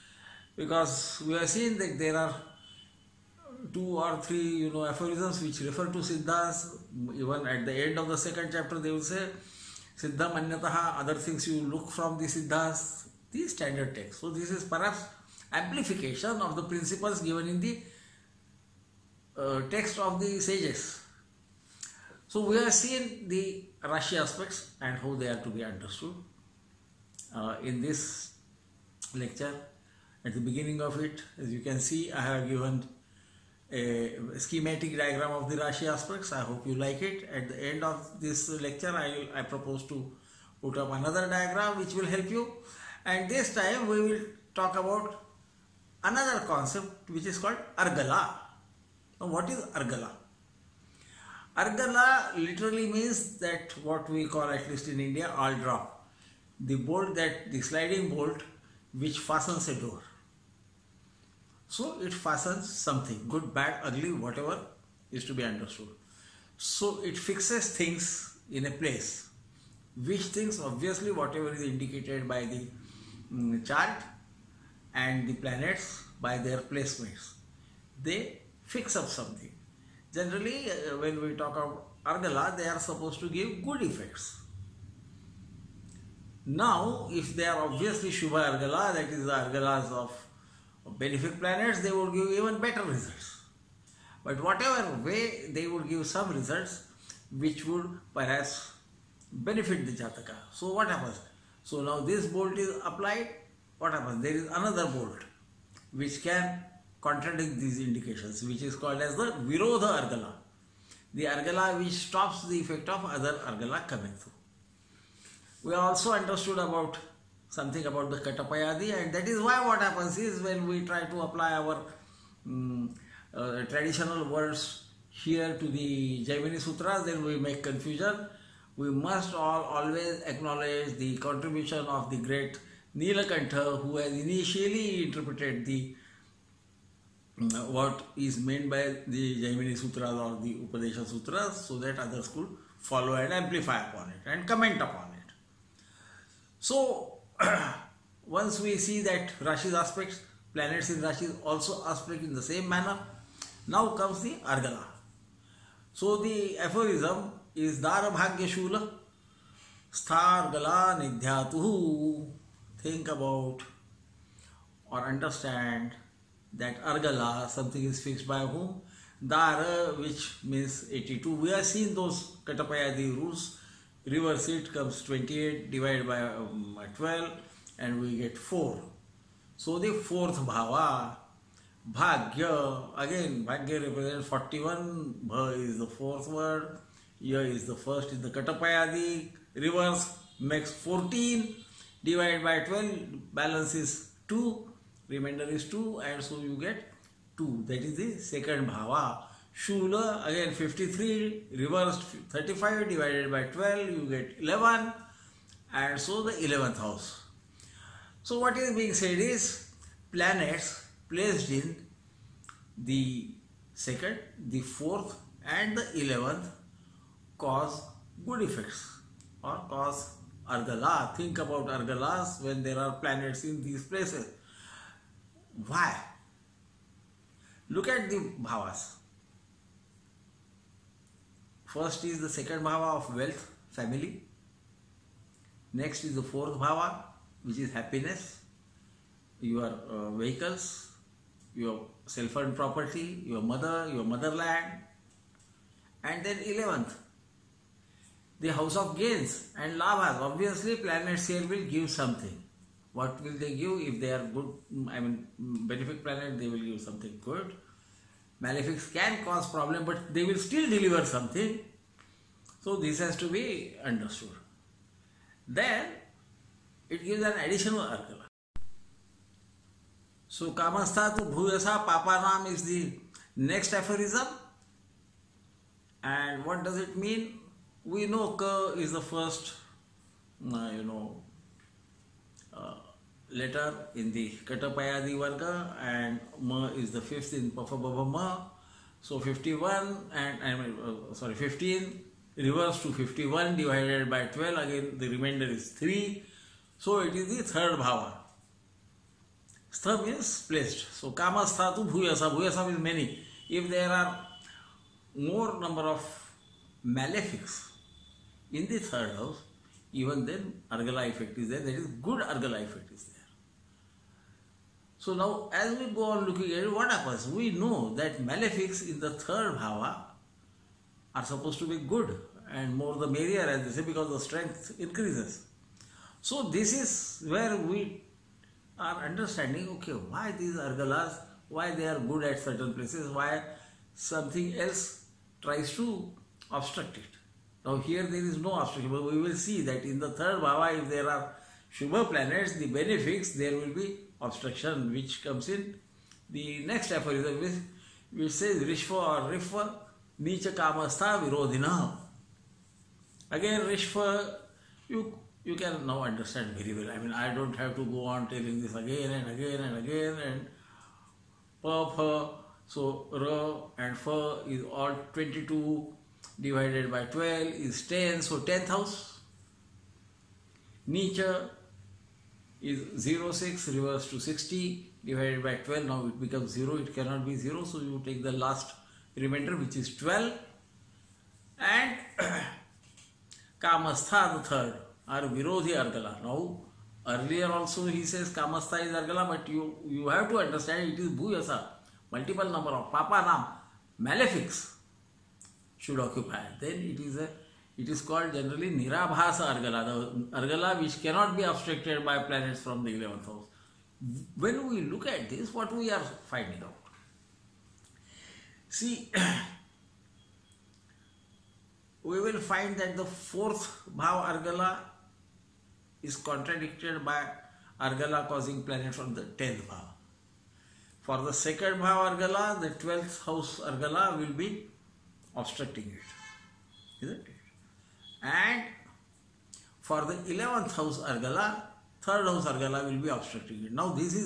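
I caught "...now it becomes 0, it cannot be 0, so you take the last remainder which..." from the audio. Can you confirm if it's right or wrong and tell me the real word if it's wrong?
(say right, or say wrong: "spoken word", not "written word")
right.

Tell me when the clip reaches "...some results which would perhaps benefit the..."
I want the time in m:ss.
1:36.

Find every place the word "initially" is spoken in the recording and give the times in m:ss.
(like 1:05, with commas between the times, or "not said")
2:14.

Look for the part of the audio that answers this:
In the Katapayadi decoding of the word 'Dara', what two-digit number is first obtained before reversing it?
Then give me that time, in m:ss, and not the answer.
2:50.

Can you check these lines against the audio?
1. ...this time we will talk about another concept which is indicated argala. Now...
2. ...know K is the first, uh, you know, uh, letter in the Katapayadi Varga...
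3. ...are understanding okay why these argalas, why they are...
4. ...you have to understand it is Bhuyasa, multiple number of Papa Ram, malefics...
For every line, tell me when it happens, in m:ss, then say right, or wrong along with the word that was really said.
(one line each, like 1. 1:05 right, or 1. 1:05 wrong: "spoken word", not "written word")
1. 0:43 wrong: "called", not "indicated"
2. 4:38 right
3. 5:28 right
4. 6:29 right.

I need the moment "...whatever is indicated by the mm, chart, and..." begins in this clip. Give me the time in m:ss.
1:11.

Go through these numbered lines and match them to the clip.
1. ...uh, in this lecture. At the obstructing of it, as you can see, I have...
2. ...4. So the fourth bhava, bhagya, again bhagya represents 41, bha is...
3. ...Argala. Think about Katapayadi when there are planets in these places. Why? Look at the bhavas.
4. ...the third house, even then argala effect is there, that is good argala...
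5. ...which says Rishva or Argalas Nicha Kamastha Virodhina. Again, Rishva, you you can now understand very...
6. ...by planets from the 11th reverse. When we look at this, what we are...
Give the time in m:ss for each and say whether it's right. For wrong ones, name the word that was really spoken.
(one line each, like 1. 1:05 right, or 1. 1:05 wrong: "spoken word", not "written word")
1. 0:27 wrong: "beginning", not "obstructing"
2. 2:58 right
3. 3:40 wrong: "Argalas", not "Katapayadi"
4. 5:08 right
5. 5:48 wrong: "Rishva", not "Argalas"
6. 6:42 wrong: "house", not "reverse".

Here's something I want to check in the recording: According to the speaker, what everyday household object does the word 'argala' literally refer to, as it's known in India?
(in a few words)
Sliding bolt.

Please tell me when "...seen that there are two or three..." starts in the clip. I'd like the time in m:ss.
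0:01.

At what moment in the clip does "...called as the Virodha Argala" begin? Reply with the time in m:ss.
1:48.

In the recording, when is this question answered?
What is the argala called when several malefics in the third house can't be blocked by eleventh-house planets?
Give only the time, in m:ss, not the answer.
6:38.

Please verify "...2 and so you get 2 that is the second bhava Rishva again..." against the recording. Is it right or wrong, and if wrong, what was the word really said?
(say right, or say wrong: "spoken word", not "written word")
wrong: "Shula", not "Rishva".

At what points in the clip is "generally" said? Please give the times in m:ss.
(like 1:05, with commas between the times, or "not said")
1:20, 6:38.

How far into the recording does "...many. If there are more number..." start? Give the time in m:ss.
5:02.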